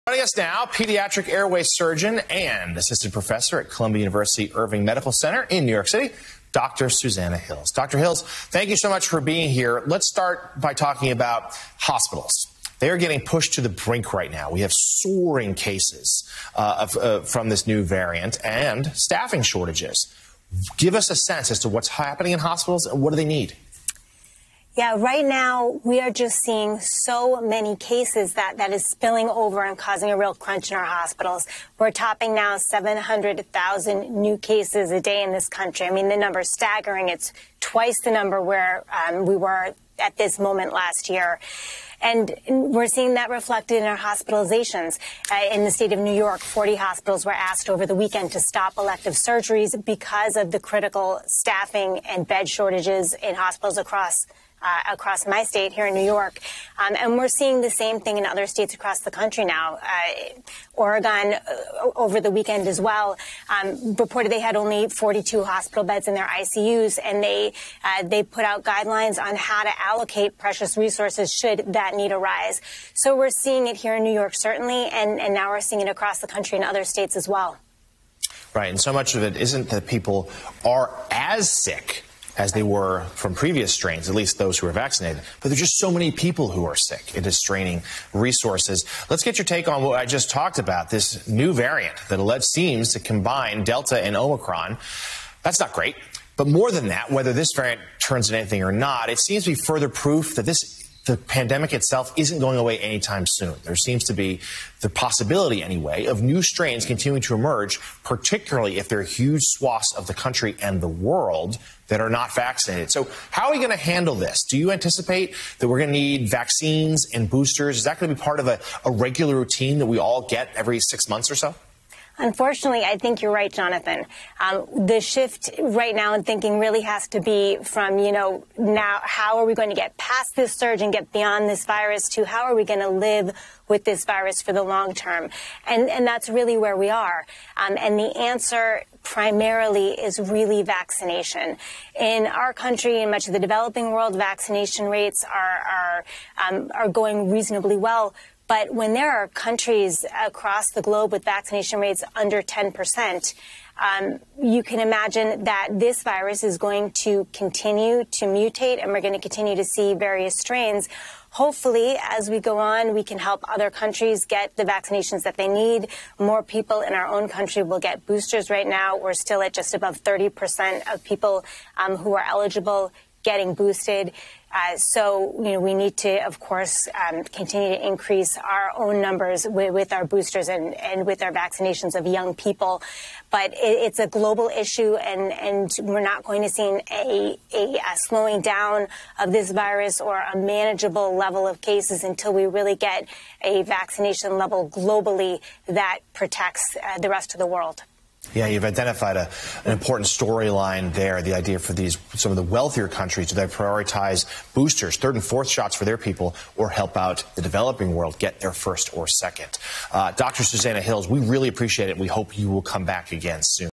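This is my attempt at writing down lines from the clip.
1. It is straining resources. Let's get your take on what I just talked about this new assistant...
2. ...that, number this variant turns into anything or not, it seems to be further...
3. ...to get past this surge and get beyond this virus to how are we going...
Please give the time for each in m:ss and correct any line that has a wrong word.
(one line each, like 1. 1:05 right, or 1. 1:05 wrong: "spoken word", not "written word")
1. 1:27 wrong: "variant", not "assistant"
2. 1:36 wrong: "whether", not "number"
3. 2:09 right.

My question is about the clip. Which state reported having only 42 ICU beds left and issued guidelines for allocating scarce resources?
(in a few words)
Oregon.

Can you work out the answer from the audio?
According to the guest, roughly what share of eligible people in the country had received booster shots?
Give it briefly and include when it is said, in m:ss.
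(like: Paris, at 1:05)
just above 30%, at 2:49.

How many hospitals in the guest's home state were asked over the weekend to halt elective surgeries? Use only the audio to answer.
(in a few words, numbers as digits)
40.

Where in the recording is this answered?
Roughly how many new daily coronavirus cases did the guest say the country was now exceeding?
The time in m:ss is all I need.
0:32.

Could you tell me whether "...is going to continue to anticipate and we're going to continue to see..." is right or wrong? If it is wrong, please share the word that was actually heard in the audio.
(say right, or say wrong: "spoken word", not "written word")
wrong: "mutate", not "anticipate".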